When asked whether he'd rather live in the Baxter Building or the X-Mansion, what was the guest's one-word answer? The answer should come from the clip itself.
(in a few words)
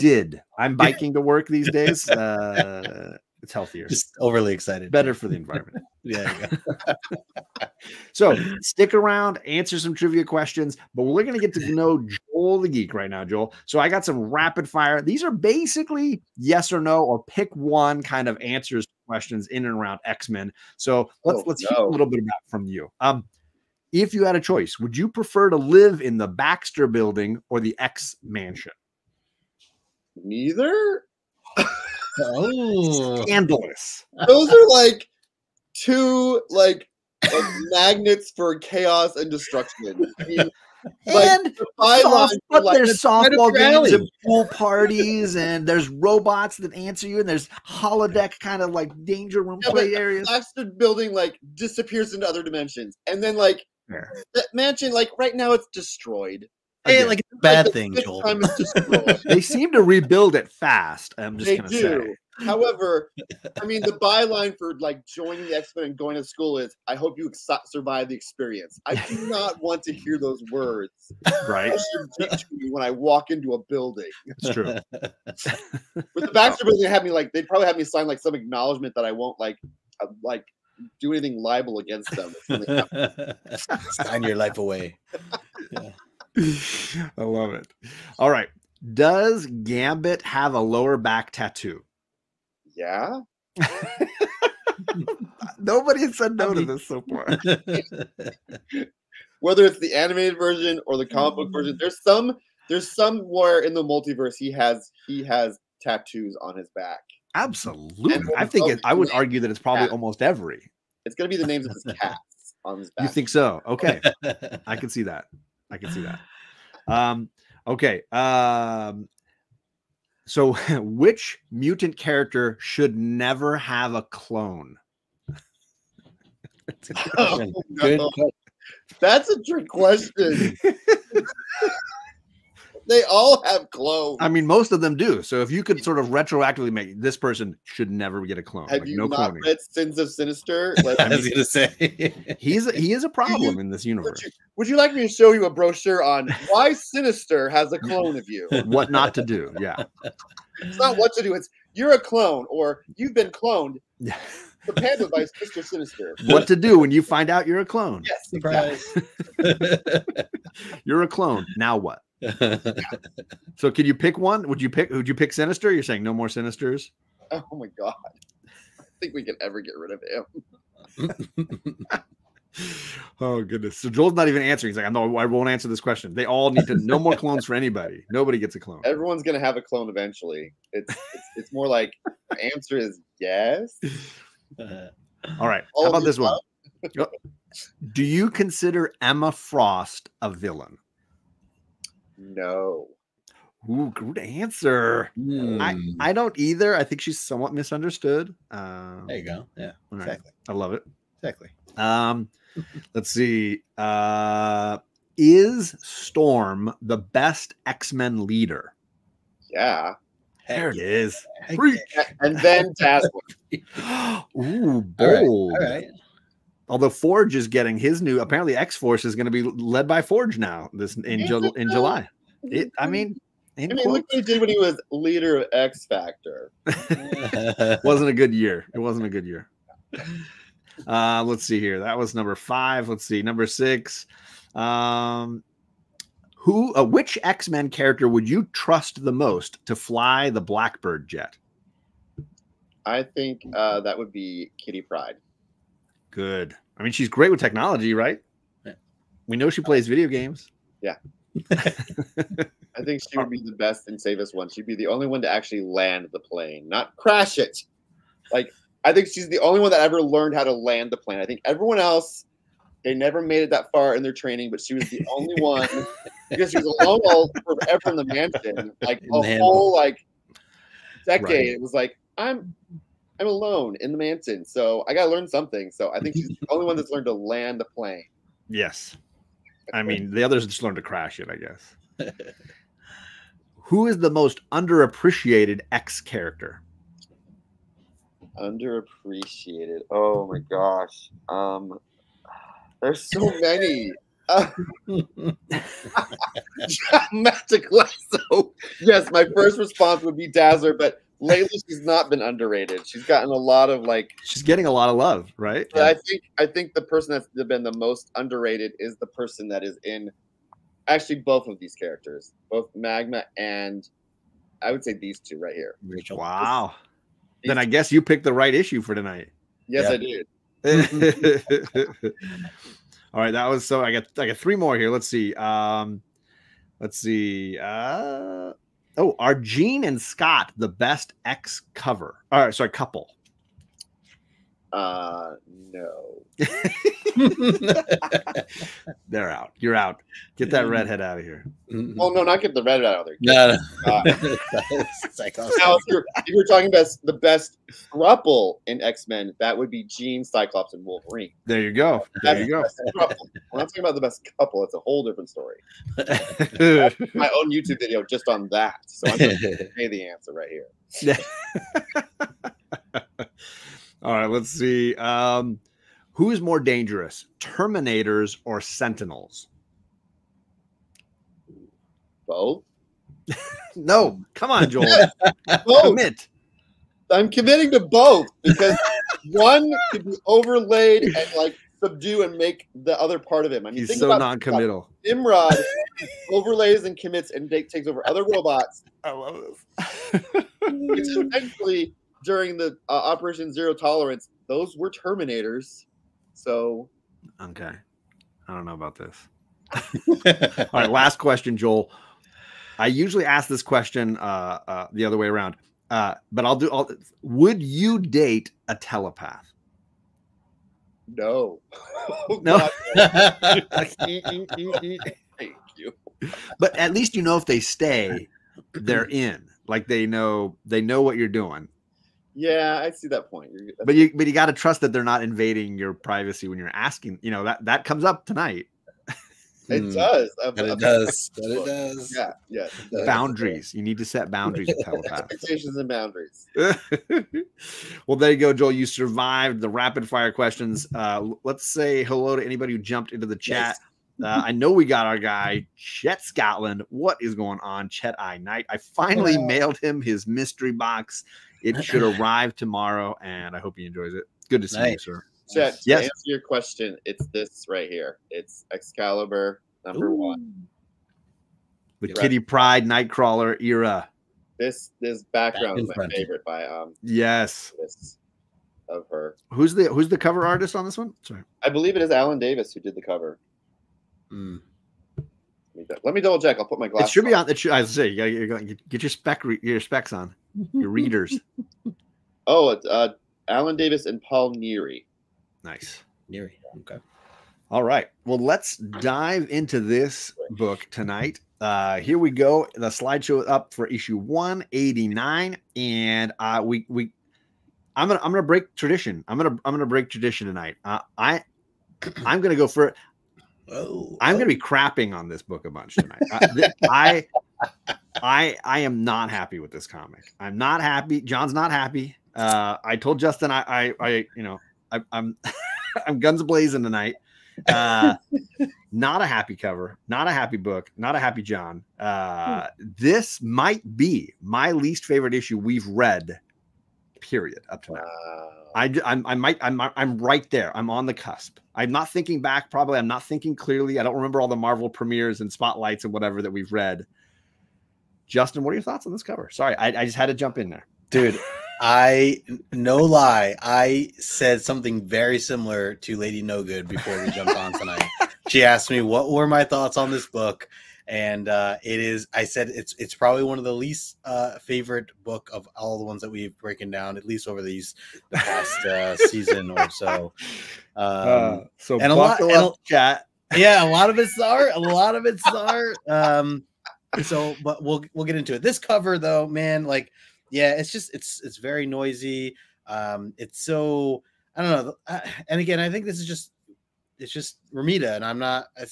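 Neither.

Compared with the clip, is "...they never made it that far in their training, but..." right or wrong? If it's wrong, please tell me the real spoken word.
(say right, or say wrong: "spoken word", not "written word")
right.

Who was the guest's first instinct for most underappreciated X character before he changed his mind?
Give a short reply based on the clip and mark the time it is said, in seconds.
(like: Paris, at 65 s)
Dazzler, at 300 s.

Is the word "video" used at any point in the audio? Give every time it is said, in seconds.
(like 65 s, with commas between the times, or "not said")
249 s, 357 s.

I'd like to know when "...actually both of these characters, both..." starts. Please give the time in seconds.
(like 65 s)
310 s.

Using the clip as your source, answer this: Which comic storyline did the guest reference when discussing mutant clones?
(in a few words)
Sins of Sinister.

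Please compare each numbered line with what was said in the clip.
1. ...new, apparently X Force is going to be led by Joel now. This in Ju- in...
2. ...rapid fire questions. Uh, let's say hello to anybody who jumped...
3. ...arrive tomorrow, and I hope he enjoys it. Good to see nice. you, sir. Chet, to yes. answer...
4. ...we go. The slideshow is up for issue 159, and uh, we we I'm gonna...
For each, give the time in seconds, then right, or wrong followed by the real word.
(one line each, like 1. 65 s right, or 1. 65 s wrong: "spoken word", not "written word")
1. 217 s wrong: "Forge", not "Joel"
2. 439 s right
3. 452 s right
4. 492 s wrong: "189", not "159".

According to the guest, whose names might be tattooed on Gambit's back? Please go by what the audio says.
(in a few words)
His cats.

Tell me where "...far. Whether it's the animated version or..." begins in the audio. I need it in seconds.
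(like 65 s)
97 s.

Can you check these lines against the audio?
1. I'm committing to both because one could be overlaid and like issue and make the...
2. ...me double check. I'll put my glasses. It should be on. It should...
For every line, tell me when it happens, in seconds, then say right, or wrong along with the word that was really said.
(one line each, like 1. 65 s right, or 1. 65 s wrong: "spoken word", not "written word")
1. 377 s wrong: "subdue", not "issue"
2. 476 s right.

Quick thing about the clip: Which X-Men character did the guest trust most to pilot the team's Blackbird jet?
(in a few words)
Kitty Pryde.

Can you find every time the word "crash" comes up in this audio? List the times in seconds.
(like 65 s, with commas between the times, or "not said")
256 s, 280 s.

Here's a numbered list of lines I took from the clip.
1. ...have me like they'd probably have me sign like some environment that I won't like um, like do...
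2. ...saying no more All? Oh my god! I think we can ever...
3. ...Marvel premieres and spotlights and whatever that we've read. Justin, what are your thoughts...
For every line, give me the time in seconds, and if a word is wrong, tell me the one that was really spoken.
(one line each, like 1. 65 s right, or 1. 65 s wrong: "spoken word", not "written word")
1. 76 s wrong: "acknowledgement", not "environment"
2. 165 s wrong: "Sinisters", not "All"
3. 534 s right.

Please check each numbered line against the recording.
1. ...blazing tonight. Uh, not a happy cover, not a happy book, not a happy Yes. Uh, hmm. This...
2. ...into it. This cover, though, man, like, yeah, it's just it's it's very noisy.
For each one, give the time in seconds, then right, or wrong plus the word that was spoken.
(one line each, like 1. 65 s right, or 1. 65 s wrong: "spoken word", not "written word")
1. 516 s wrong: "John", not "Yes"
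2. 568 s right.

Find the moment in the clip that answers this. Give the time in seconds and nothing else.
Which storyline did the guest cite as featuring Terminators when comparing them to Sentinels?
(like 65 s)
392 s.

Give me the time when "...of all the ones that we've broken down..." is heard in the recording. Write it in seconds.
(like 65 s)
555 s.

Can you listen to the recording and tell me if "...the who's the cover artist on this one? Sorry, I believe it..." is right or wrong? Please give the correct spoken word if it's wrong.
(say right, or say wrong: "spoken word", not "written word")
right.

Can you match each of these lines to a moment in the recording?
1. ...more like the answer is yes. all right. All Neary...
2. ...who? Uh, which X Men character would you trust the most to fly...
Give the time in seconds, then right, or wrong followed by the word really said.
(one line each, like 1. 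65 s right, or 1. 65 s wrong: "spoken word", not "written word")
1. 181 s wrong: "How", not "Neary"
2. 236 s right.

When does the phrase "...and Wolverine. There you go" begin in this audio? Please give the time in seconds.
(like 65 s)
350 s.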